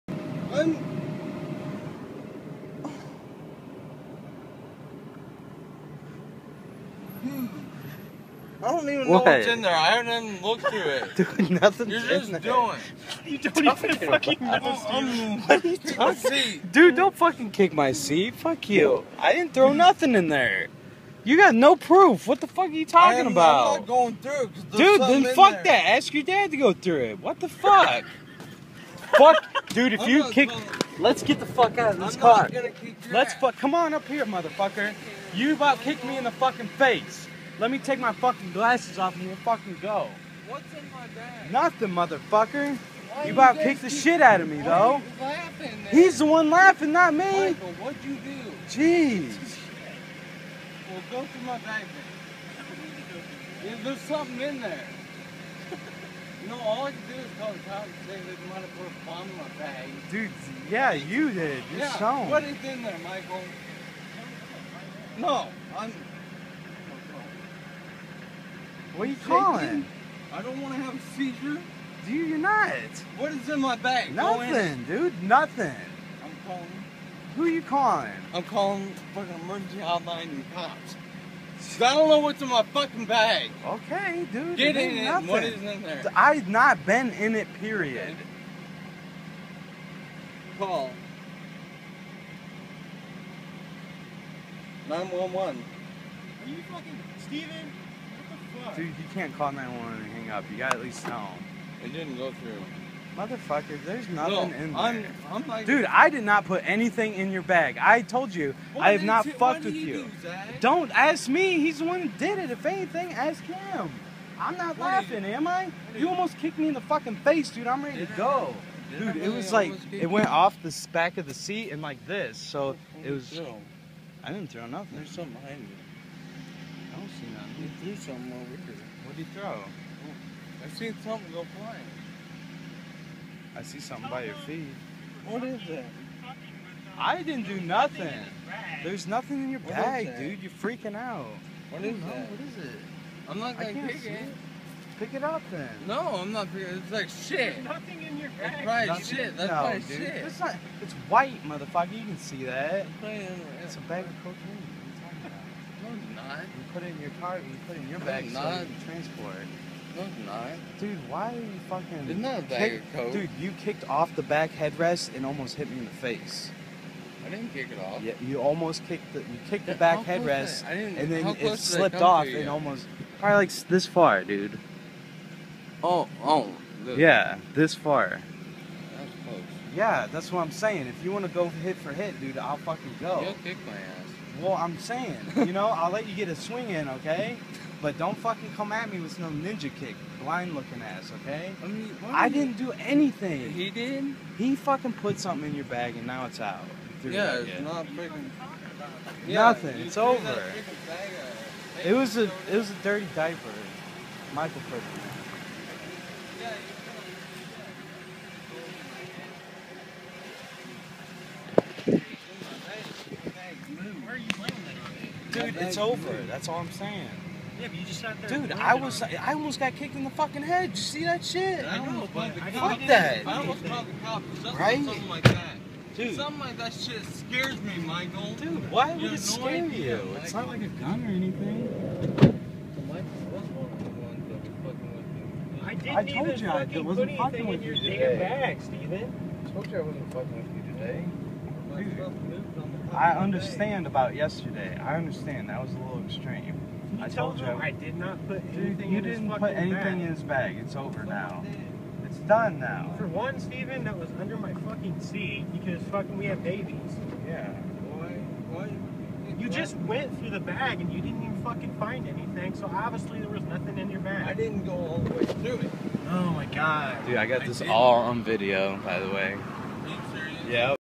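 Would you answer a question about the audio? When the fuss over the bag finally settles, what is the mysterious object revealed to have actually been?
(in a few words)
dirty diaper.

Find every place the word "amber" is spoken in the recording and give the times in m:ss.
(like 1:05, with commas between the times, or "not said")
not said.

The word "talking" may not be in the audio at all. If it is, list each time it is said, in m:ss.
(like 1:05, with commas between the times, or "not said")
0:15, 0:22, 2:36.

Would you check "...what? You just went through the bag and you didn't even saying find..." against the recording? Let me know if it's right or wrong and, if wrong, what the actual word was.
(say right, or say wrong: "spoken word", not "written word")
wrong: "fucking", not "saying".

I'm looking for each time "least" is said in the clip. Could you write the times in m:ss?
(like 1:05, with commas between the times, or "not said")
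1:40.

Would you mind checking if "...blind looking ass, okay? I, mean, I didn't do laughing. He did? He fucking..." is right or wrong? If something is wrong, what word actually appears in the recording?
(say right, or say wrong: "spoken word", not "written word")
wrong: "anything", not "laughing".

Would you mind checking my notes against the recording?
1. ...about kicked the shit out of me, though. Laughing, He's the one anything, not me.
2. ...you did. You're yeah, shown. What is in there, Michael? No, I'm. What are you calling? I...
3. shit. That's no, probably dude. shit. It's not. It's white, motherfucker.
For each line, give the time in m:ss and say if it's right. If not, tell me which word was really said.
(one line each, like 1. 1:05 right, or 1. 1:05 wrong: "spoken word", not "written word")
1. 0:43 wrong: "laughing", not "anything"
2. 1:00 right
3. 2:29 right.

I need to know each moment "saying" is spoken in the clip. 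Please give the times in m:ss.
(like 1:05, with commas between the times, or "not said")
3:00, 3:04, 3:36.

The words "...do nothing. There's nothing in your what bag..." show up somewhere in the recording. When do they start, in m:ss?
2:17.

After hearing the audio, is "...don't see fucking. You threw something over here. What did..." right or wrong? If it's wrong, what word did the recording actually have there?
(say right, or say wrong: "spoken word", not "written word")
wrong: "nothing", not "fucking".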